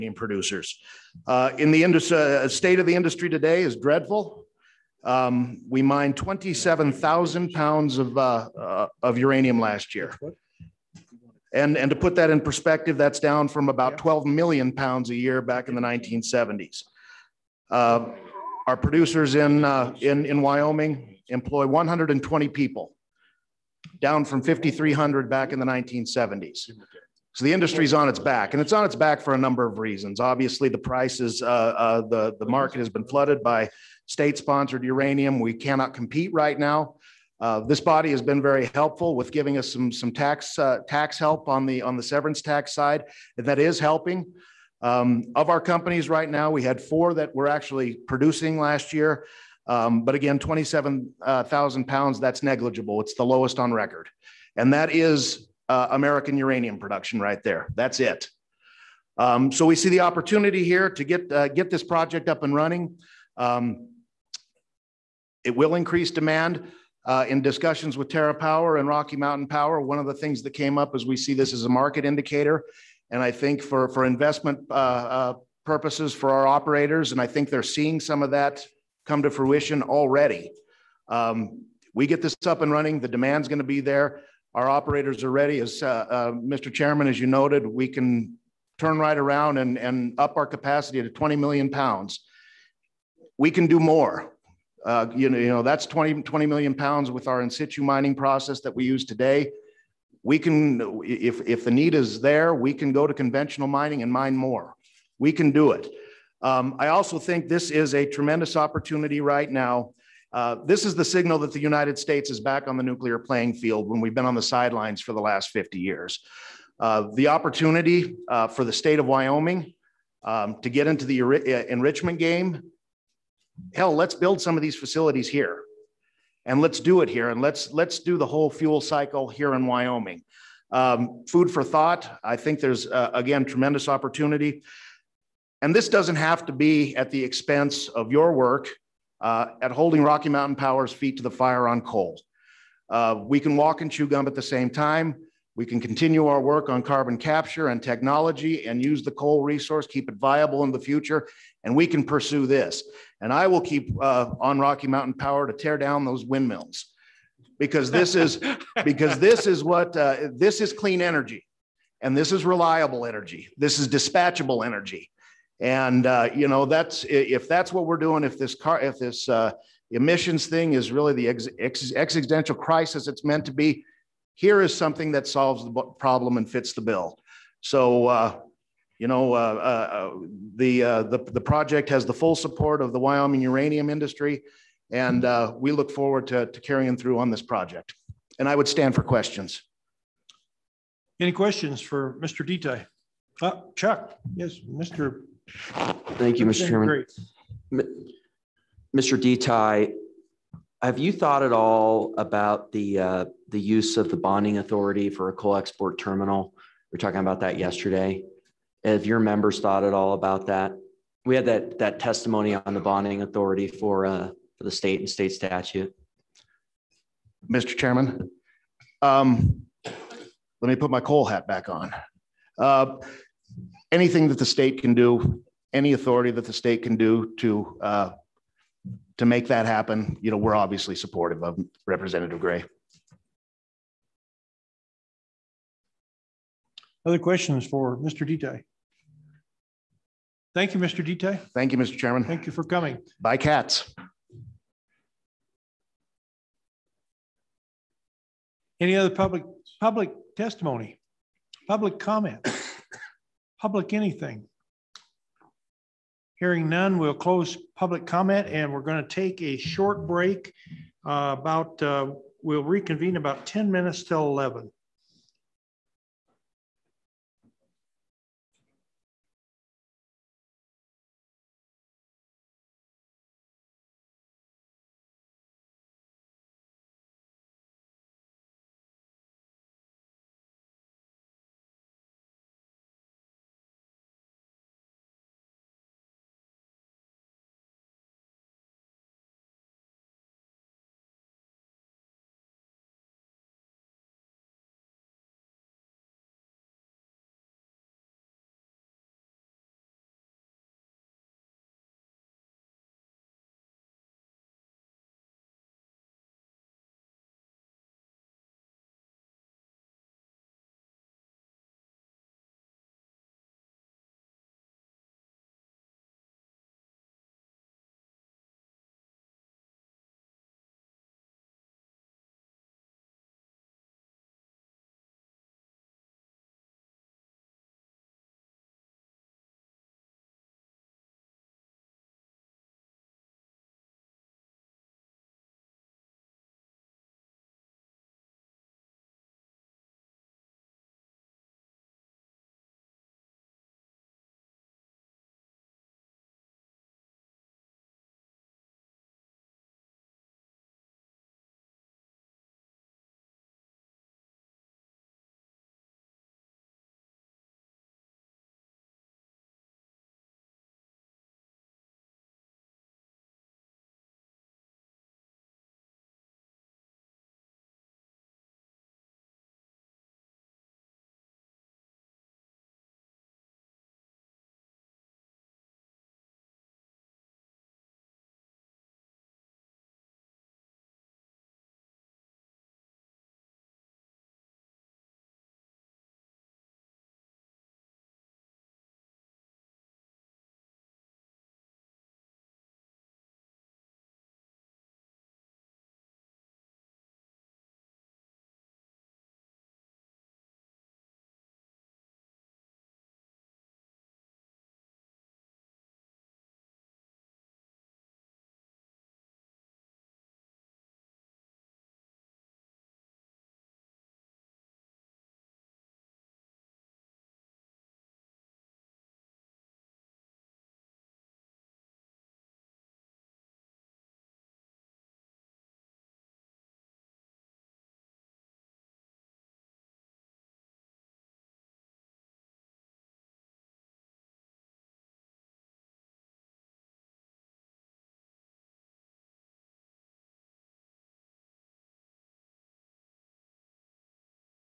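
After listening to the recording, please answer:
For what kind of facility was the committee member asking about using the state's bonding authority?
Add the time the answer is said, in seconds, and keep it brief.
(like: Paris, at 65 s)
coal export terminal, at 205 s.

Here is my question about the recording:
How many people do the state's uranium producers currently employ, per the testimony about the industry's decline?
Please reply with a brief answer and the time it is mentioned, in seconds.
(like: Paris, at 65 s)
120, at 21 s.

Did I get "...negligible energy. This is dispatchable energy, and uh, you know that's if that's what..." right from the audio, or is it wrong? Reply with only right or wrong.
wrong.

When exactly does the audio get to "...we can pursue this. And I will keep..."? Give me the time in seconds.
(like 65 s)
151 s.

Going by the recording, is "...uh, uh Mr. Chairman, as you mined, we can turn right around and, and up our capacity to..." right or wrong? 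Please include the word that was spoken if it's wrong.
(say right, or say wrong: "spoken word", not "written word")
wrong: "noted", not "mined".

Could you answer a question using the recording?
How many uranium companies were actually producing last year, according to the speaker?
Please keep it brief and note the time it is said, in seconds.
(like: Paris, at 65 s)
4, at 46 s.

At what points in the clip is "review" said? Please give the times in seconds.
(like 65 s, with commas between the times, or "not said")
not said.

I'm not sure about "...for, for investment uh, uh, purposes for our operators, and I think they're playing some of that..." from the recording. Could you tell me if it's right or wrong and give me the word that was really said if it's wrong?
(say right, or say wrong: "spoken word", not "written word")
wrong: "seeing", not "playing".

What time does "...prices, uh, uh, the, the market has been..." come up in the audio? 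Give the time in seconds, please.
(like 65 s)
30 s.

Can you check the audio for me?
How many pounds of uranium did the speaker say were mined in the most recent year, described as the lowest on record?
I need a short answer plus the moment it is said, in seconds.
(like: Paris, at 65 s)
27,000 pounds, at 6 s.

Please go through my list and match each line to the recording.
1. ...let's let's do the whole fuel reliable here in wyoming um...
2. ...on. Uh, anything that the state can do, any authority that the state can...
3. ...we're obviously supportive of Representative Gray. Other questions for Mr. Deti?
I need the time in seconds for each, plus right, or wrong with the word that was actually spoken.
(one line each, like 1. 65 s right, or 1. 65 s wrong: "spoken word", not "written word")
1. 127 s wrong: "cycle", not "reliable"
2. 221 s right
3. 230 s right.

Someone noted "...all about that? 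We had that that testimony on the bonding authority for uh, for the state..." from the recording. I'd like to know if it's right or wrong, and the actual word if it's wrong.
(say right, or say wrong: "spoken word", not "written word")
right.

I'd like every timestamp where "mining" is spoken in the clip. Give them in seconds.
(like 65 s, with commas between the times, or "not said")
97 s, 103 s.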